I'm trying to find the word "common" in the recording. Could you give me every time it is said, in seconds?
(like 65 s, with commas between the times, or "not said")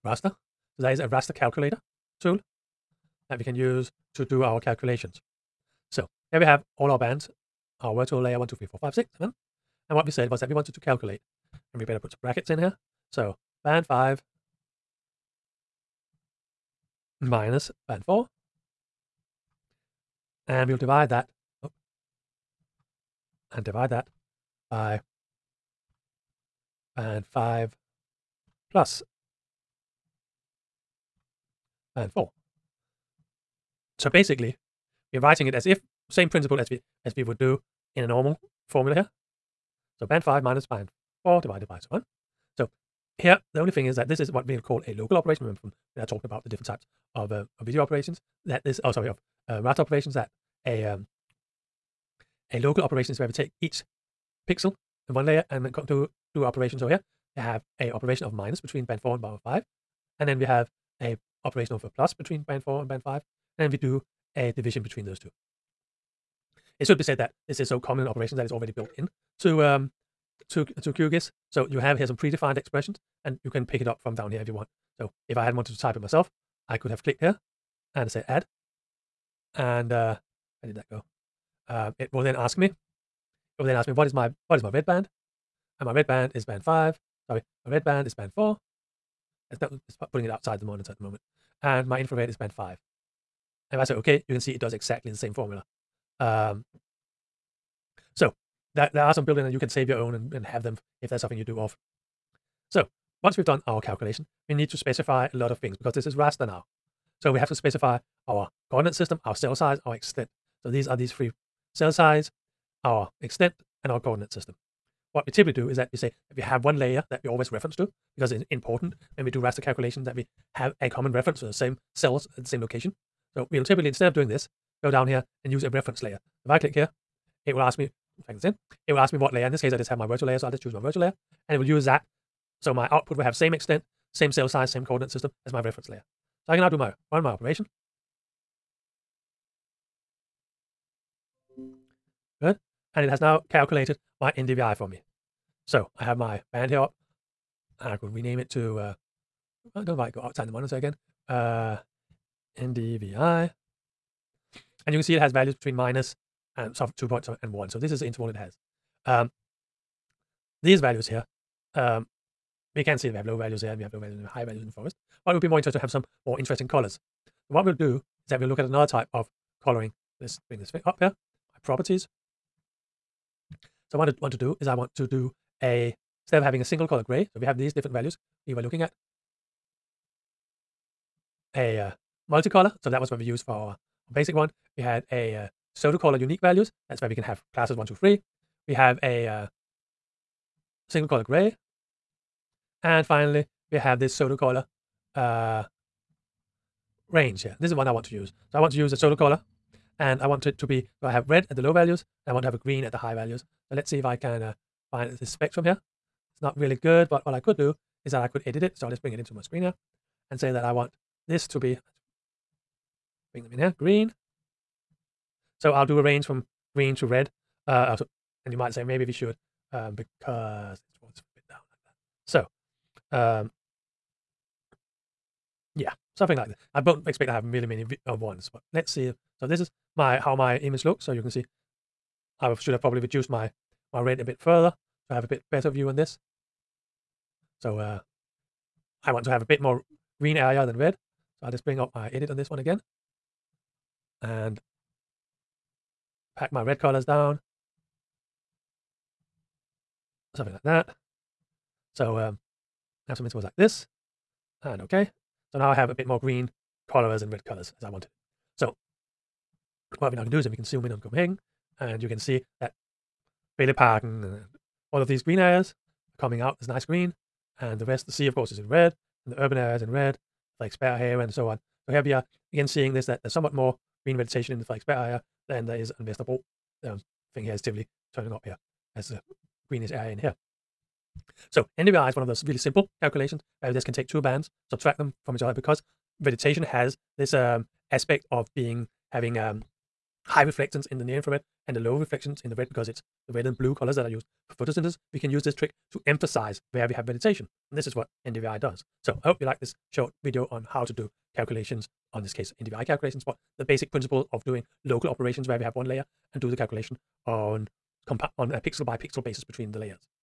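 67 s, 120 s.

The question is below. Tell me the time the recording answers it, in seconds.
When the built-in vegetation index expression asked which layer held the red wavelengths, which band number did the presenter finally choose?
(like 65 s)
87 s.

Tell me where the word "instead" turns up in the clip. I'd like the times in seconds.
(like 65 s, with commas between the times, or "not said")
123 s, 176 s.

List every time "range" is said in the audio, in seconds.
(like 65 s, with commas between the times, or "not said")
197 s, 216 s.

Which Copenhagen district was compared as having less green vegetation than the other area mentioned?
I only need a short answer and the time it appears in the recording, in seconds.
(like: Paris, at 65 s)
Vesterbro, at 276 s.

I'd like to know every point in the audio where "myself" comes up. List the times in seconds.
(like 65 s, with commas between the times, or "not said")
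75 s.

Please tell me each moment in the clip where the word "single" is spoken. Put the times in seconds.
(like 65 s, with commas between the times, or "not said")
176 s, 190 s.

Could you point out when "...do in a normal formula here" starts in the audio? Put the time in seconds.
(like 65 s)
37 s.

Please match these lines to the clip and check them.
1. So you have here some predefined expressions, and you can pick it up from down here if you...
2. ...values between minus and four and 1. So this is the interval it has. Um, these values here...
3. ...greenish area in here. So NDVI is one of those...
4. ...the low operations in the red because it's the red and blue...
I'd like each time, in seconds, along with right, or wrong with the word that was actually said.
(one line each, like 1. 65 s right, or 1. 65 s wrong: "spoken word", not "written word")
1. 71 s right
2. 155 s wrong: "two", not "four"
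3. 279 s right
4. 291 s wrong: "reflections", not "operations".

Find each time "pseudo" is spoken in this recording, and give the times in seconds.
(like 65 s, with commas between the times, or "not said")
185 s, 194 s, 198 s.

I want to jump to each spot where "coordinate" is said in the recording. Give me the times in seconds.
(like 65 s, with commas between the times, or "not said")
108 s, 113 s, 134 s.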